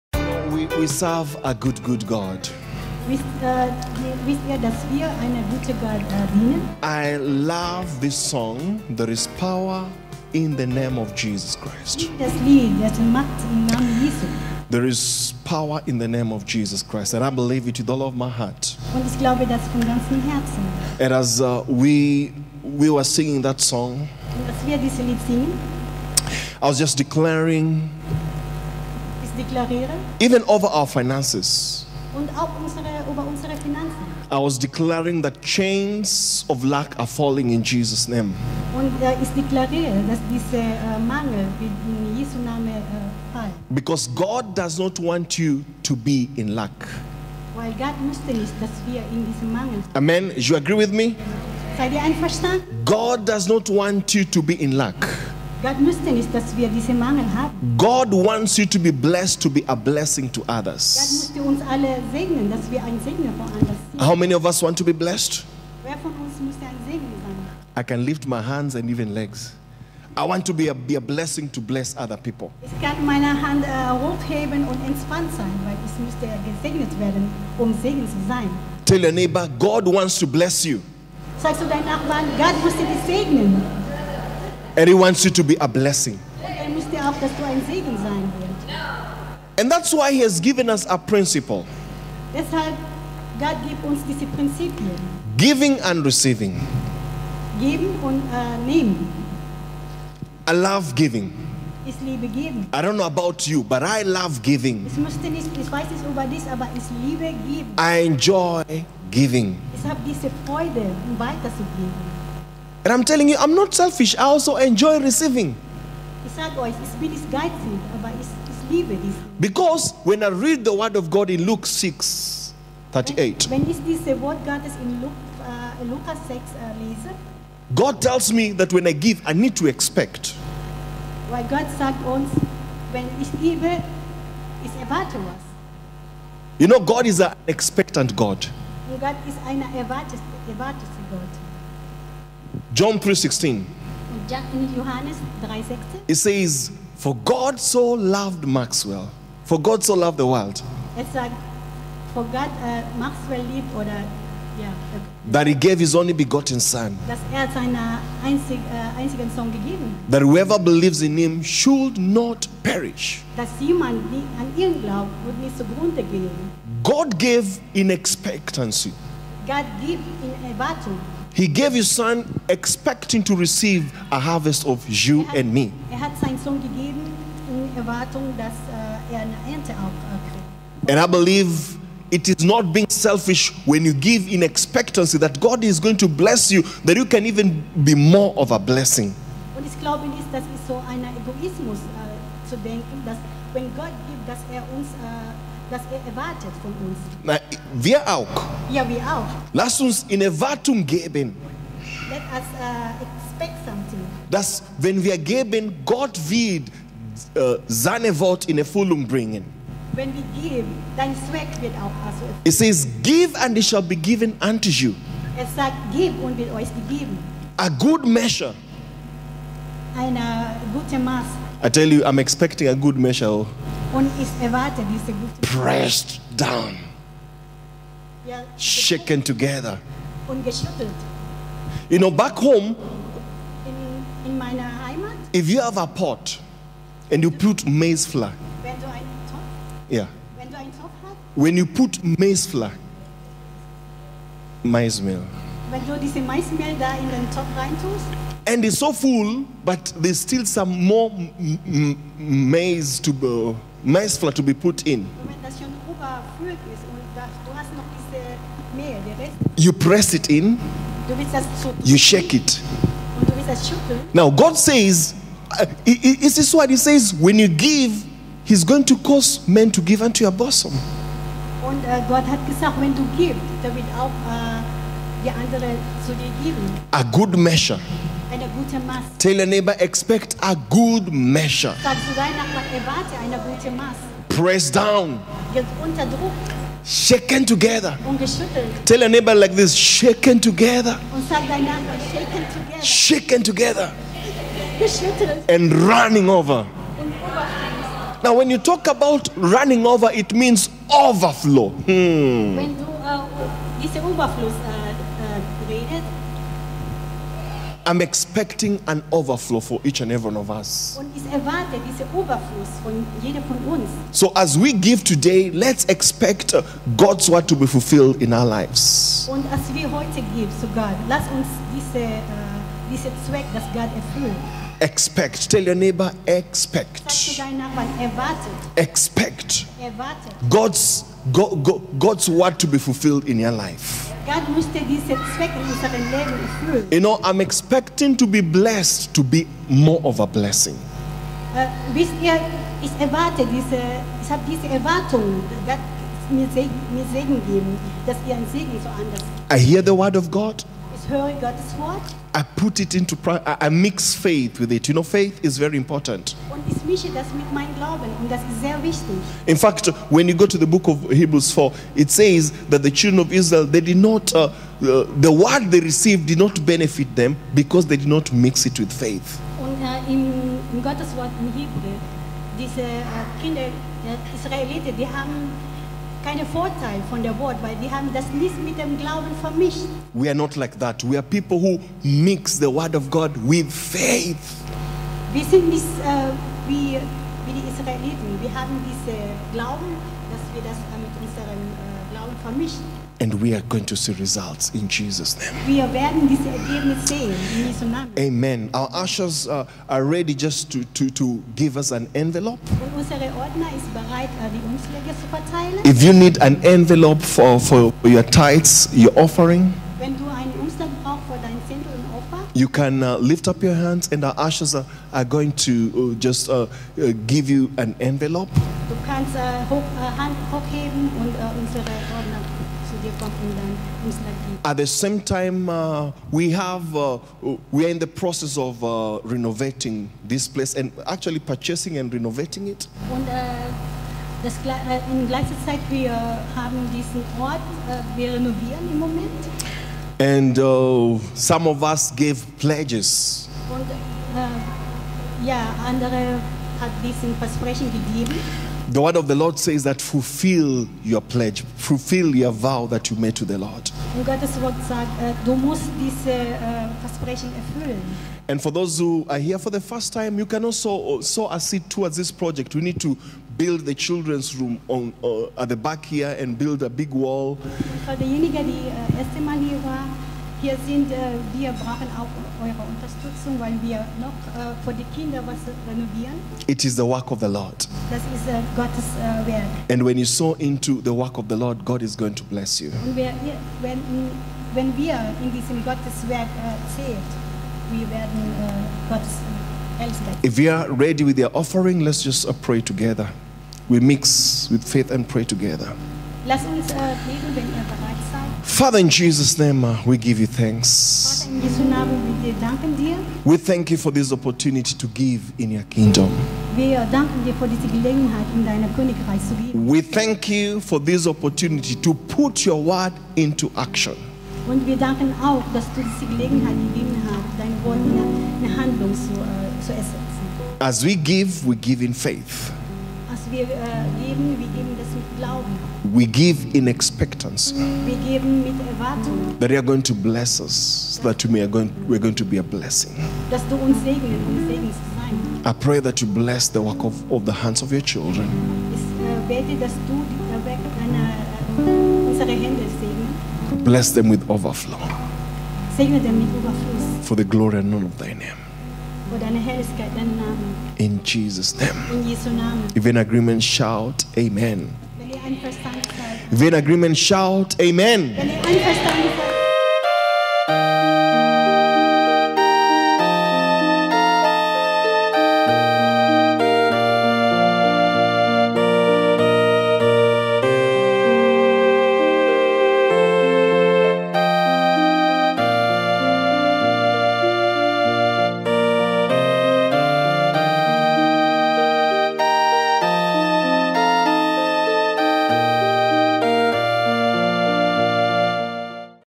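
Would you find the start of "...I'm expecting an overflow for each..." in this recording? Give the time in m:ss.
5:07.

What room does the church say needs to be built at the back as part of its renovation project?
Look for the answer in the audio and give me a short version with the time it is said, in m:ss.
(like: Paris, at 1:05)
Children's room, at 7:43.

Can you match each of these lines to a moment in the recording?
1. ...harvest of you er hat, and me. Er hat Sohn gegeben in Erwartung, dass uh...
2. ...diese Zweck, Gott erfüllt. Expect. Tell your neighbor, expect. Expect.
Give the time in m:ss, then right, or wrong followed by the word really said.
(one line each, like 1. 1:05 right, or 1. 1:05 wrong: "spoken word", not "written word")
1. 2:54 right
2. 5:22 right.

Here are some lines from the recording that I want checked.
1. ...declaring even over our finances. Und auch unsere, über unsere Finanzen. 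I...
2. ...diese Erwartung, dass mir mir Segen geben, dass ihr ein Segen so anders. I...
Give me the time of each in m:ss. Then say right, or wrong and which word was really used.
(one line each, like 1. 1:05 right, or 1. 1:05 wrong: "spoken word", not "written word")
1. 0:26 right
2. 5:44 right.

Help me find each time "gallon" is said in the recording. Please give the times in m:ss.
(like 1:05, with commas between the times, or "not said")
not said.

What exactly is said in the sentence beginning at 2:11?
Weil Gott sagt uns, wenn ich gebe, ich erwarte was.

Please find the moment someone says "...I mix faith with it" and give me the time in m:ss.
5:53.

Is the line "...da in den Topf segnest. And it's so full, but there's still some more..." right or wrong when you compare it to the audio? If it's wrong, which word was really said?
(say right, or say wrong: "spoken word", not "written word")
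wrong: "reintust", not "segnest".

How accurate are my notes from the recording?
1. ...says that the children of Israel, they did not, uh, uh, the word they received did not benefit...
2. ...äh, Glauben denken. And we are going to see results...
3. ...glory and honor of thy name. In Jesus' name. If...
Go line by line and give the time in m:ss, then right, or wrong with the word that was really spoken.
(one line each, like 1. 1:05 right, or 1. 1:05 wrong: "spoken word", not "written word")
1. 6:02 right
2. 6:31 wrong: "vermischen", not "denken"
3. 9:07 right.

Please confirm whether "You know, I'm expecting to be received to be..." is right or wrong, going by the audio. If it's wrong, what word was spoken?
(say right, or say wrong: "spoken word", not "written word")
wrong: "blessed", not "received".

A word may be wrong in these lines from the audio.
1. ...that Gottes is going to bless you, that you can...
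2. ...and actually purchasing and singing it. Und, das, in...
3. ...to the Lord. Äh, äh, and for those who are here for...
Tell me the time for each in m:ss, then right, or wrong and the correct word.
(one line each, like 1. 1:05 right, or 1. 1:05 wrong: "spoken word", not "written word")
1. 3:05 wrong: "God", not "Gottes"
2. 7:10 wrong: "renovating", not "singing"
3. 7:33 right.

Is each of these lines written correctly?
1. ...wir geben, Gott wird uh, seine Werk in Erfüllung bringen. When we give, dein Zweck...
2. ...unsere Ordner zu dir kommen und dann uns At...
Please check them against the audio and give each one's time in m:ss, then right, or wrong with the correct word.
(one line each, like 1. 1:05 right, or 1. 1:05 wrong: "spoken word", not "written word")
1. 3:25 wrong: "Wort", not "Werk"
2. 7:01 right.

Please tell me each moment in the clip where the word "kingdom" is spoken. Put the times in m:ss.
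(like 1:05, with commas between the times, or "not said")
8:25.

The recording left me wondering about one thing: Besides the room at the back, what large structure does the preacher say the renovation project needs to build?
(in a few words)
A big wall.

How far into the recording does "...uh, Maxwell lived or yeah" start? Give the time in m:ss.
2:32.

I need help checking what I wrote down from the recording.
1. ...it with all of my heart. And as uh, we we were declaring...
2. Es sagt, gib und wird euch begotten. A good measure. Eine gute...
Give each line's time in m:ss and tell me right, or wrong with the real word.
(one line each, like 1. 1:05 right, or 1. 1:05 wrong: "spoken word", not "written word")
1. 0:17 wrong: "singing", not "declaring"
2. 3:35 wrong: "gegeben", not "begotten".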